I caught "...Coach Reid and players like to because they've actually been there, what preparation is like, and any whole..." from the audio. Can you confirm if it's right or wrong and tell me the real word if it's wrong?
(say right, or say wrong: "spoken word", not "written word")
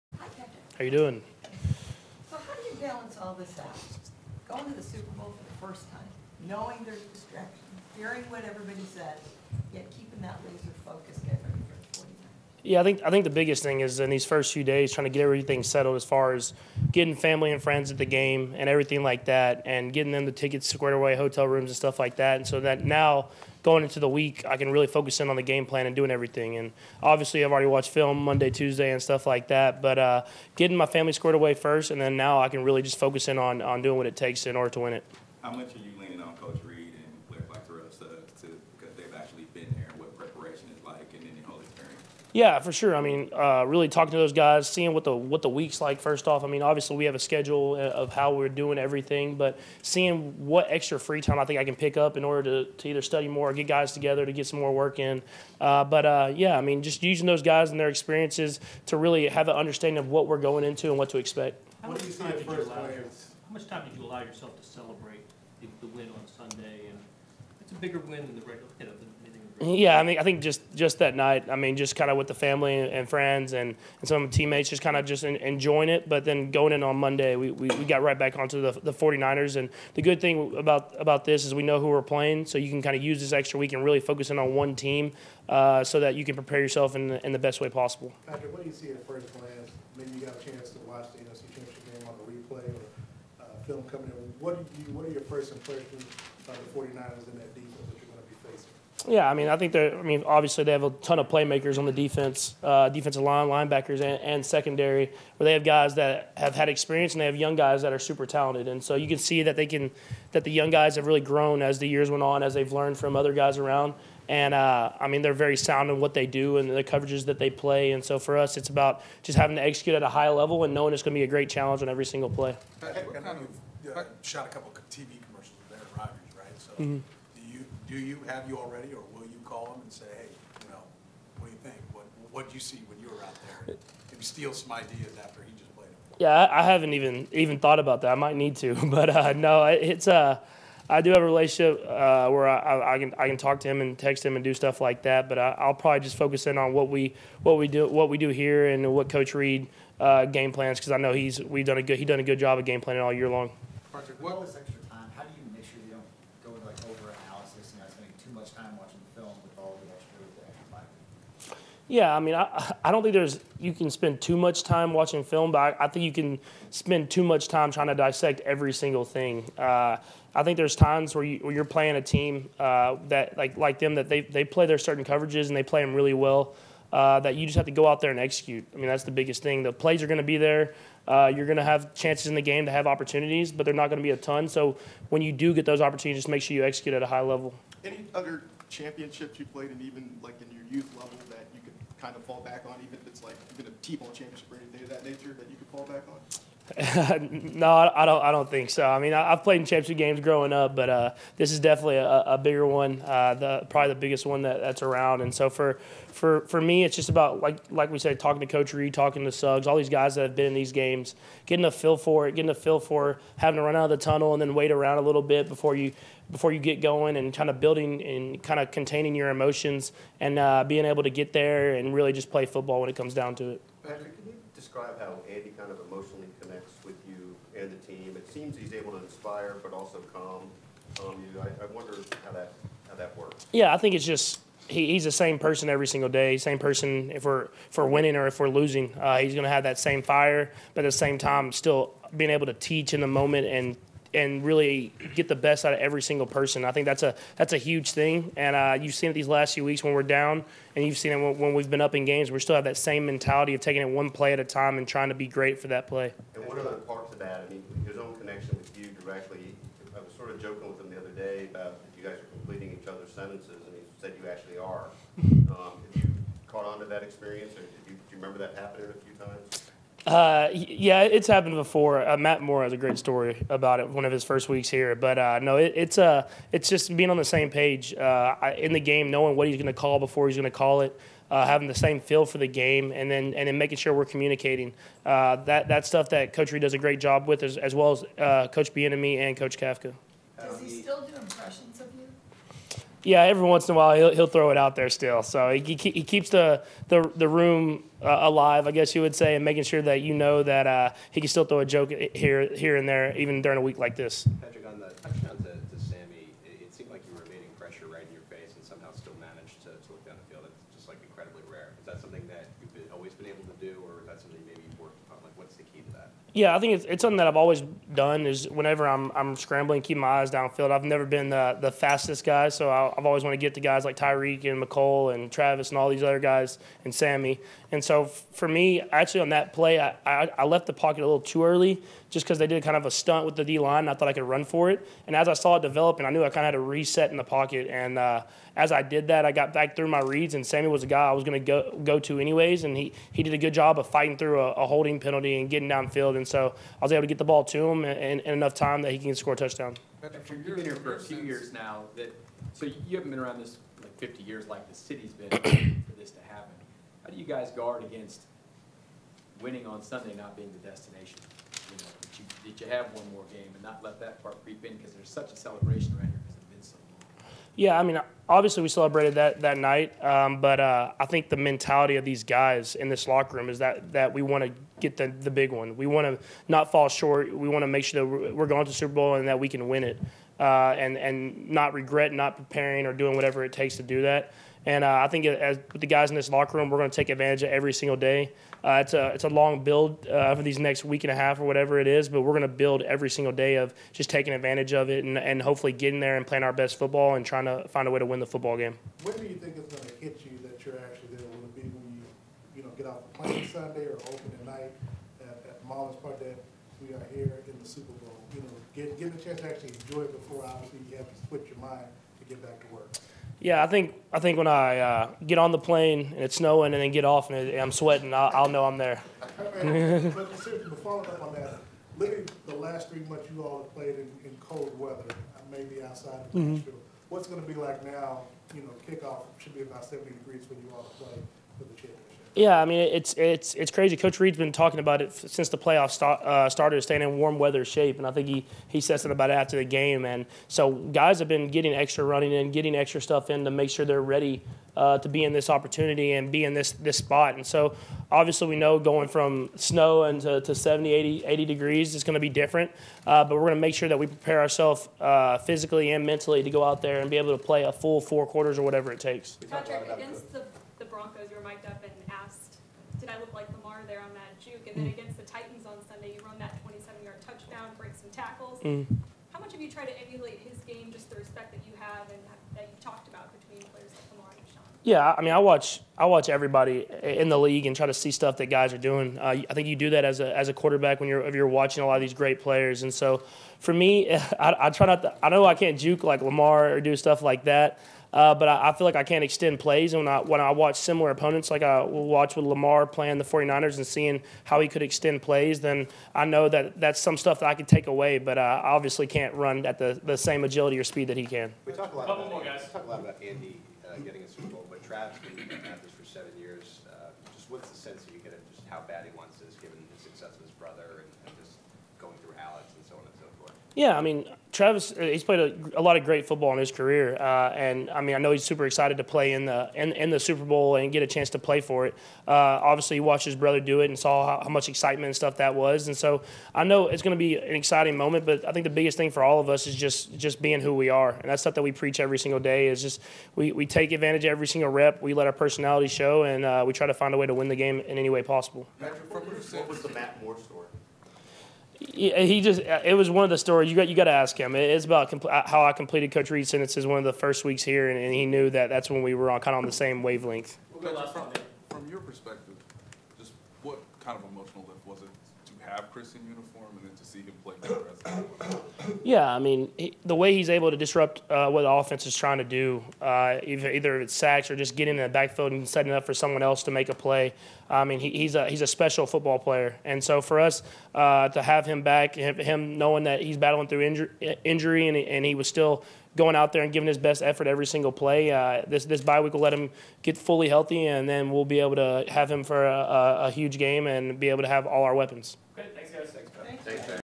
right.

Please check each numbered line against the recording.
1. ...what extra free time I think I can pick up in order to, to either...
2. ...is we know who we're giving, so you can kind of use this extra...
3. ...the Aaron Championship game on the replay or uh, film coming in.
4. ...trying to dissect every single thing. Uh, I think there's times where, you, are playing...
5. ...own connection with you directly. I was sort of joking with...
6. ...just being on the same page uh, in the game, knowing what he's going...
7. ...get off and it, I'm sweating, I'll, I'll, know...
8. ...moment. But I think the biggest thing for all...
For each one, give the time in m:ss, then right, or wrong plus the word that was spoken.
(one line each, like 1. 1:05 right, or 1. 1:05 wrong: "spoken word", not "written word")
1. 0:50 right
2. 1:21 wrong: "playing", not "giving"
3. 1:31 wrong: "NFC", not "Aaron"
4. 2:47 right
5. 4:17 right
6. 4:36 right
7. 6:56 right
8. 8:47 right.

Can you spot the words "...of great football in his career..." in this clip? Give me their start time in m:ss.
8:35.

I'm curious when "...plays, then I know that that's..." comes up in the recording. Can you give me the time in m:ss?
8:15.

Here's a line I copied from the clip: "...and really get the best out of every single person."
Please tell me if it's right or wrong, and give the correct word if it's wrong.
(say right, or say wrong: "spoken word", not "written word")
right.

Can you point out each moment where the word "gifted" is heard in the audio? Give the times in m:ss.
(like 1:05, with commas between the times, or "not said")
not said.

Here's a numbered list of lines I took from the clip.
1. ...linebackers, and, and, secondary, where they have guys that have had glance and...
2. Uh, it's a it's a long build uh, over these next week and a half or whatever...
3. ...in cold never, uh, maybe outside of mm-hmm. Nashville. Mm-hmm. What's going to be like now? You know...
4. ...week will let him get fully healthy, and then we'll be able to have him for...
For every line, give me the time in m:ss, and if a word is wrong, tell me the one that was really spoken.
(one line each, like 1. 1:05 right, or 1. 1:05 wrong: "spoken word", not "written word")
1. 1:43 wrong: "experience", not "glance"
2. 6:28 right
3. 7:04 wrong: "weather", not "never"
4. 9:39 right.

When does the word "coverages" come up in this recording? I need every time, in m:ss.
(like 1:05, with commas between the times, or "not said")
1:56, 2:55.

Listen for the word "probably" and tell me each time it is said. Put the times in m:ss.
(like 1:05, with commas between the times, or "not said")
2:25, 3:23.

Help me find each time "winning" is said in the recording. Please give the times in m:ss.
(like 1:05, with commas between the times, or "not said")
3:57, 5:59.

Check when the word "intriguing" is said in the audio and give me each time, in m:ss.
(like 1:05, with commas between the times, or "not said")
not said.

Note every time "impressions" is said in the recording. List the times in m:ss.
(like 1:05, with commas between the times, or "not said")
1:35, 4:51.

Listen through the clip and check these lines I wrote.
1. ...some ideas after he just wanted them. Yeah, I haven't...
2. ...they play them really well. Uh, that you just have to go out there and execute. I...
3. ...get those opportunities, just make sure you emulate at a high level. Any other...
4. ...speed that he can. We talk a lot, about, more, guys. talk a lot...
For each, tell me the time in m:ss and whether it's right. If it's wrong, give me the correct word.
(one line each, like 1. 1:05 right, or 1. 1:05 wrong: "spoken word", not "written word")
1. 2:14 wrong: "played", not "wanted"
2. 2:55 right
3. 3:05 wrong: "execute", not "emulate"
4. 8:20 right.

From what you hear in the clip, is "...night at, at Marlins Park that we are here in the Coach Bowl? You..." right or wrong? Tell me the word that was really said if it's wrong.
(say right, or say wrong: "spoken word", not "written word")
wrong: "Super", not "Coach".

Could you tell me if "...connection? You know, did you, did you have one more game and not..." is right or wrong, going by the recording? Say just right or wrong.
wrong.